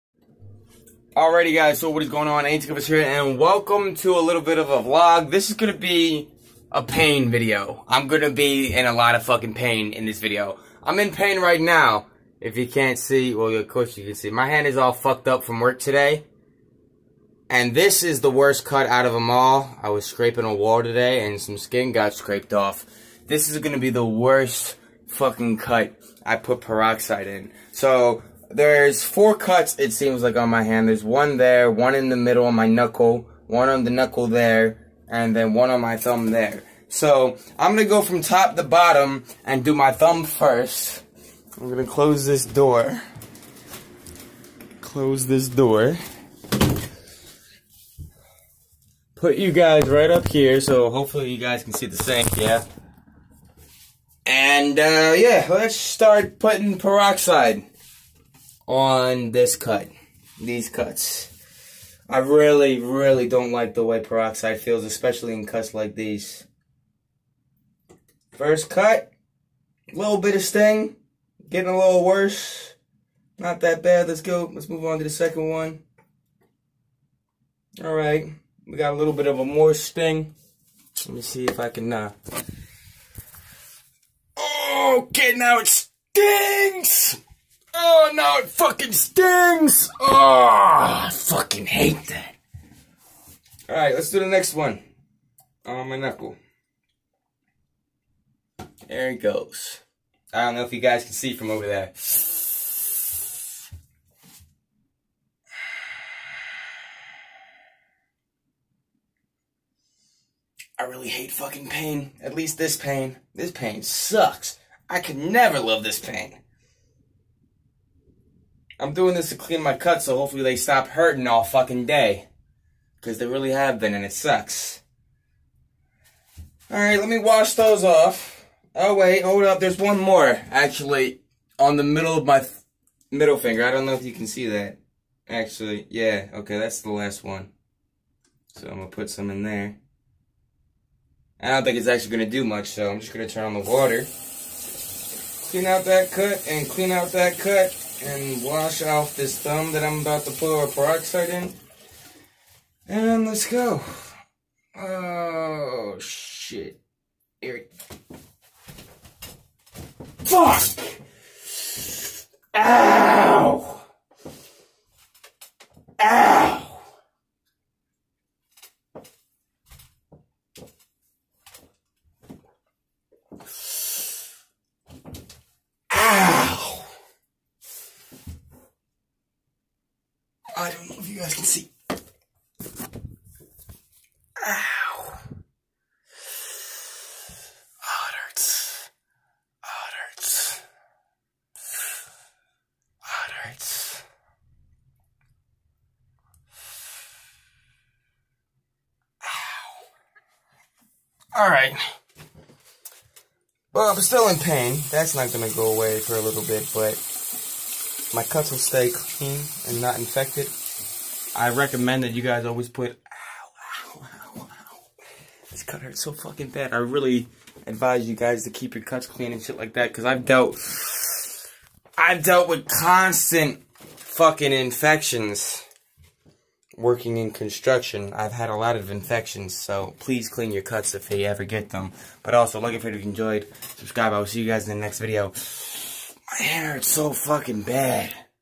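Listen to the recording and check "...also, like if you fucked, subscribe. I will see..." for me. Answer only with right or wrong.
wrong.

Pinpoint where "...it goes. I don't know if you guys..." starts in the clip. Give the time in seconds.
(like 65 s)
99 s.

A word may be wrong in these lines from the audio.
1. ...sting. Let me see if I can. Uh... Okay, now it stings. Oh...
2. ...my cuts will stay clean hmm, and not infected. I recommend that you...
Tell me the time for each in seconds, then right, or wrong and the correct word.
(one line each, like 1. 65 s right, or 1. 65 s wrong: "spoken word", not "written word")
1. 79 s right
2. 208 s right.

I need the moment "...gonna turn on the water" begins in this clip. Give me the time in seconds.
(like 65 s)
143 s.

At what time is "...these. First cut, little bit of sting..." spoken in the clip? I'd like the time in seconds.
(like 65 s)
65 s.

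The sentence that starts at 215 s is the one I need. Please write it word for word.
This cut hurts so fucking bad.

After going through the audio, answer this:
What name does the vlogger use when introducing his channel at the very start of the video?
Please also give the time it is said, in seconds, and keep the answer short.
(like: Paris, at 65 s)
A&C Covers, at 2 s.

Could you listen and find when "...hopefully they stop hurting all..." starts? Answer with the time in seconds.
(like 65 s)
120 s.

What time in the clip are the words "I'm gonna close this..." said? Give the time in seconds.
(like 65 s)
41 s.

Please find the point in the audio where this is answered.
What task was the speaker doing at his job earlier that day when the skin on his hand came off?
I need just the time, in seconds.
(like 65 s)
20 s.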